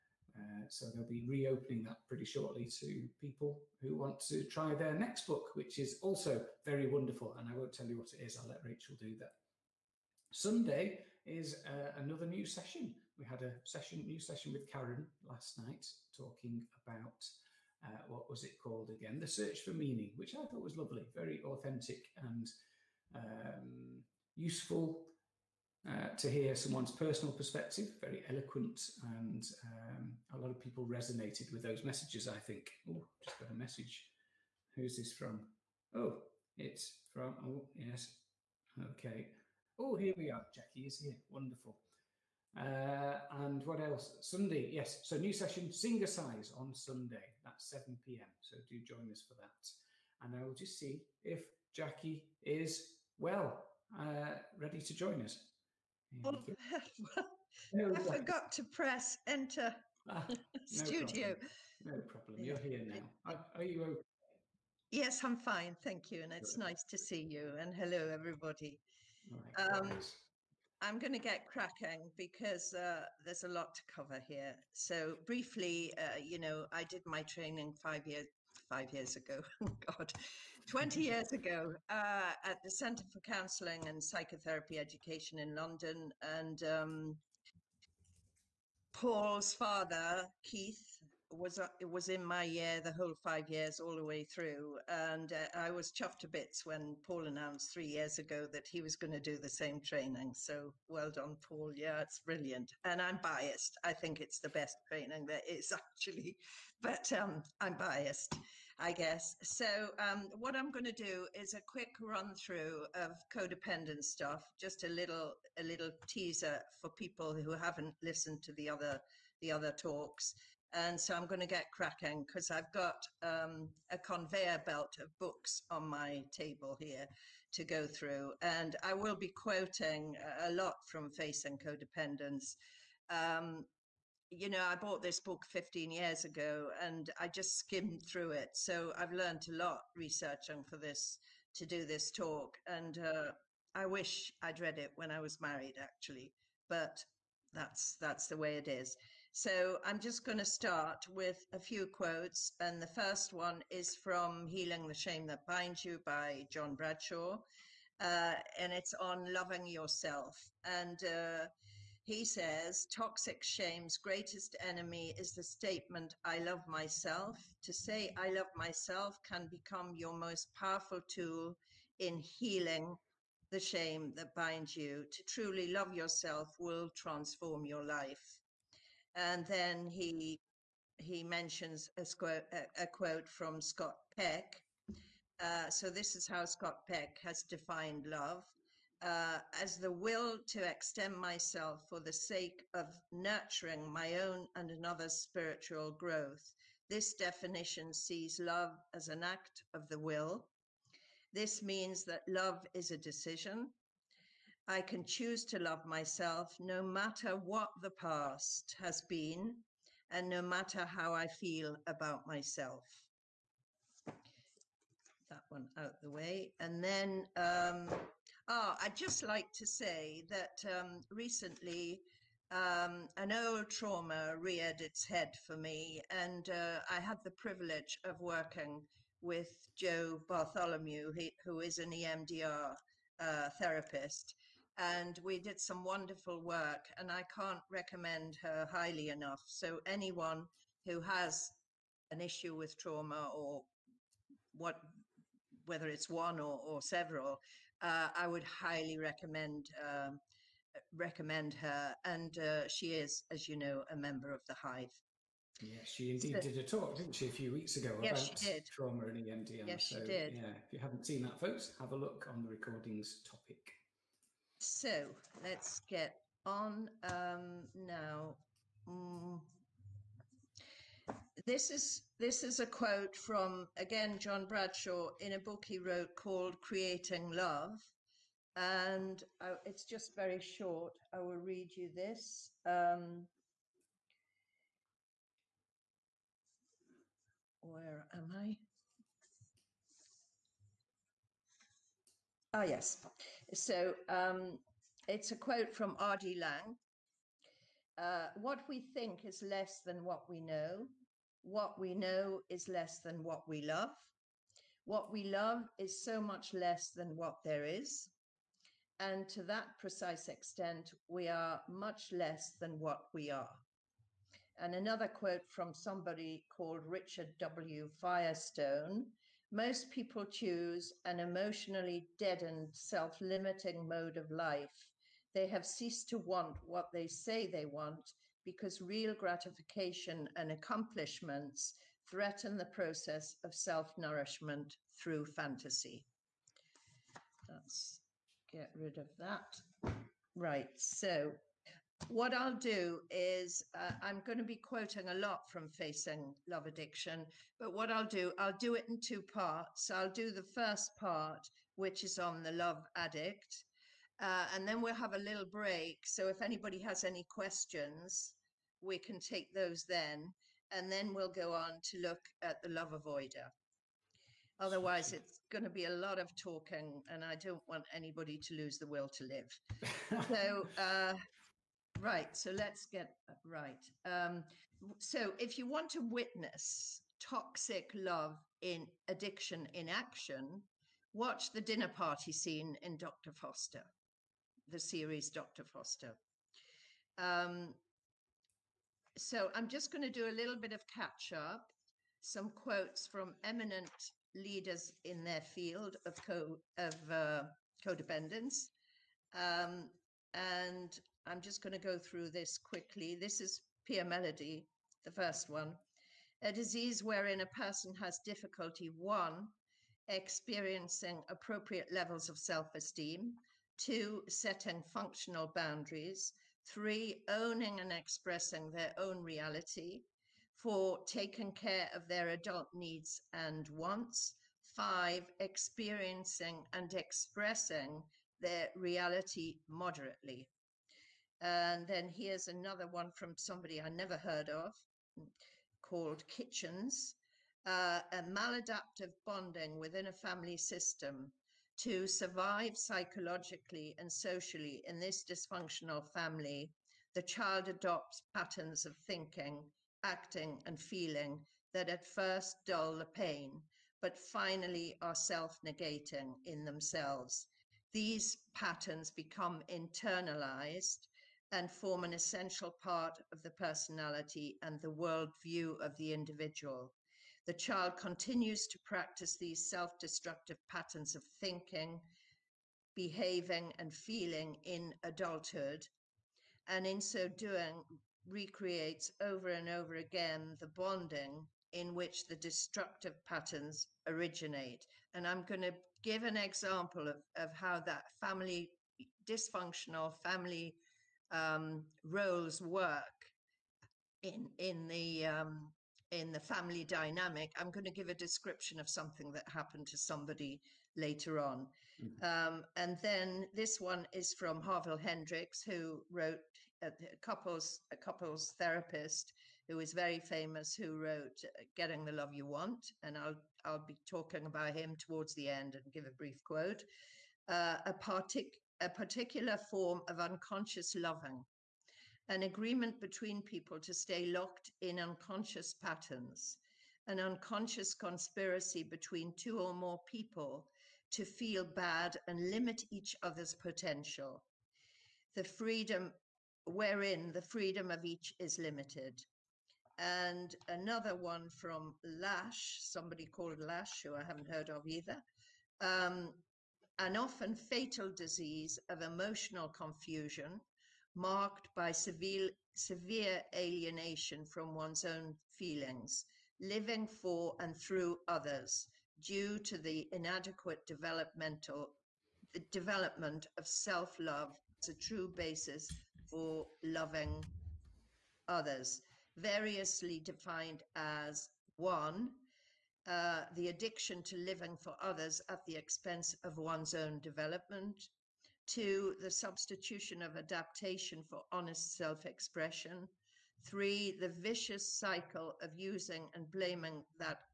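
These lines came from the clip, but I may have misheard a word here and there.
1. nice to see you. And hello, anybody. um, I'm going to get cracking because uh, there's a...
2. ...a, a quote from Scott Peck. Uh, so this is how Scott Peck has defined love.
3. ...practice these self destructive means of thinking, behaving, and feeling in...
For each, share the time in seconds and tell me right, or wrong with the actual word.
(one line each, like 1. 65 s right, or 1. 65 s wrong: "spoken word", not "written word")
1. 66 s wrong: "everybody", not "anybody"
2. 182 s right
3. 468 s wrong: "patterns", not "means".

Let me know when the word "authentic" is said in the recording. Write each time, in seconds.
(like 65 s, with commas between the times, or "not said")
21 s.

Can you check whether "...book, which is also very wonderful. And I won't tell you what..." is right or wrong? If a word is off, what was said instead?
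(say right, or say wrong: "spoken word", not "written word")
right.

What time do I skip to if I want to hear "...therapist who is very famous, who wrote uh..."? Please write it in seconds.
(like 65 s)
508 s.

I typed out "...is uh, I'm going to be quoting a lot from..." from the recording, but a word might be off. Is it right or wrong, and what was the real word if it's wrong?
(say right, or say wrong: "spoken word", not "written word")
right.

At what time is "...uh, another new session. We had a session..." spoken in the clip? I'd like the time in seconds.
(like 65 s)
11 s.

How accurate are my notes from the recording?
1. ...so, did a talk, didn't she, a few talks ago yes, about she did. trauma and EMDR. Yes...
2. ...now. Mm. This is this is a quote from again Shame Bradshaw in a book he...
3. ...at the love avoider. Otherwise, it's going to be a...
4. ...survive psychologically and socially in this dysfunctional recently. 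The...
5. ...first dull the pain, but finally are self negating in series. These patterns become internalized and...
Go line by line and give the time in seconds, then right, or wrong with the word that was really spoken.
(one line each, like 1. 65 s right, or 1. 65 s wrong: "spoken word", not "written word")
1. 256 s wrong: "weeks", not "talks"
2. 267 s wrong: "John", not "Shame"
3. 362 s right
4. 442 s wrong: "family", not "recently"
5. 452 s wrong: "themselves", not "series".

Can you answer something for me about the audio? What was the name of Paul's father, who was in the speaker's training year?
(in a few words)
Keith.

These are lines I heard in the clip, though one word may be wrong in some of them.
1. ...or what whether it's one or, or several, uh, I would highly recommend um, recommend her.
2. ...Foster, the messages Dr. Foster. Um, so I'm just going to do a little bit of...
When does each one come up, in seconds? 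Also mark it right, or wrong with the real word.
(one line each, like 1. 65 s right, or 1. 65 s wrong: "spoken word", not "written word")
1. 243 s right
2. 383 s wrong: "series", not "messages".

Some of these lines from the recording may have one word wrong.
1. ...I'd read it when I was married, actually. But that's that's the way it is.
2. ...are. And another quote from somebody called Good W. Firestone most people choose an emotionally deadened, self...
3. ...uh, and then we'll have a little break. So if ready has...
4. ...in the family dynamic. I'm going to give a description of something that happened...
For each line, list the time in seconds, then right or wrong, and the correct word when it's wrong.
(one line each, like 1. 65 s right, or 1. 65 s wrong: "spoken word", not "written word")
1. 144 s right
2. 313 s wrong: "Richard", not "Good"
3. 354 s wrong: "anybody", not "ready"
4. 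496 s right.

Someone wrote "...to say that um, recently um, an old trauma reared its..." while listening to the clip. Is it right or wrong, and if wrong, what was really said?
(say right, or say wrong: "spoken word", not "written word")
right.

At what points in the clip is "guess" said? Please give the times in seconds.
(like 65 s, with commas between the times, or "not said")
108 s.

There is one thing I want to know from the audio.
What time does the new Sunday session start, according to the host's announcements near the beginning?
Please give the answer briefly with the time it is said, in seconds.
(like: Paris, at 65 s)
7 p.m., at 47 s.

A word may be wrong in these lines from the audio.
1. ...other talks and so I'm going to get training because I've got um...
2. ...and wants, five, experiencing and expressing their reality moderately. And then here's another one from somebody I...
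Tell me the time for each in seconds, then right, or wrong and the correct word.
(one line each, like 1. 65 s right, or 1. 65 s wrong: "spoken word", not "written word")
1. 119 s wrong: "cracking", not "training"
2. 423 s right.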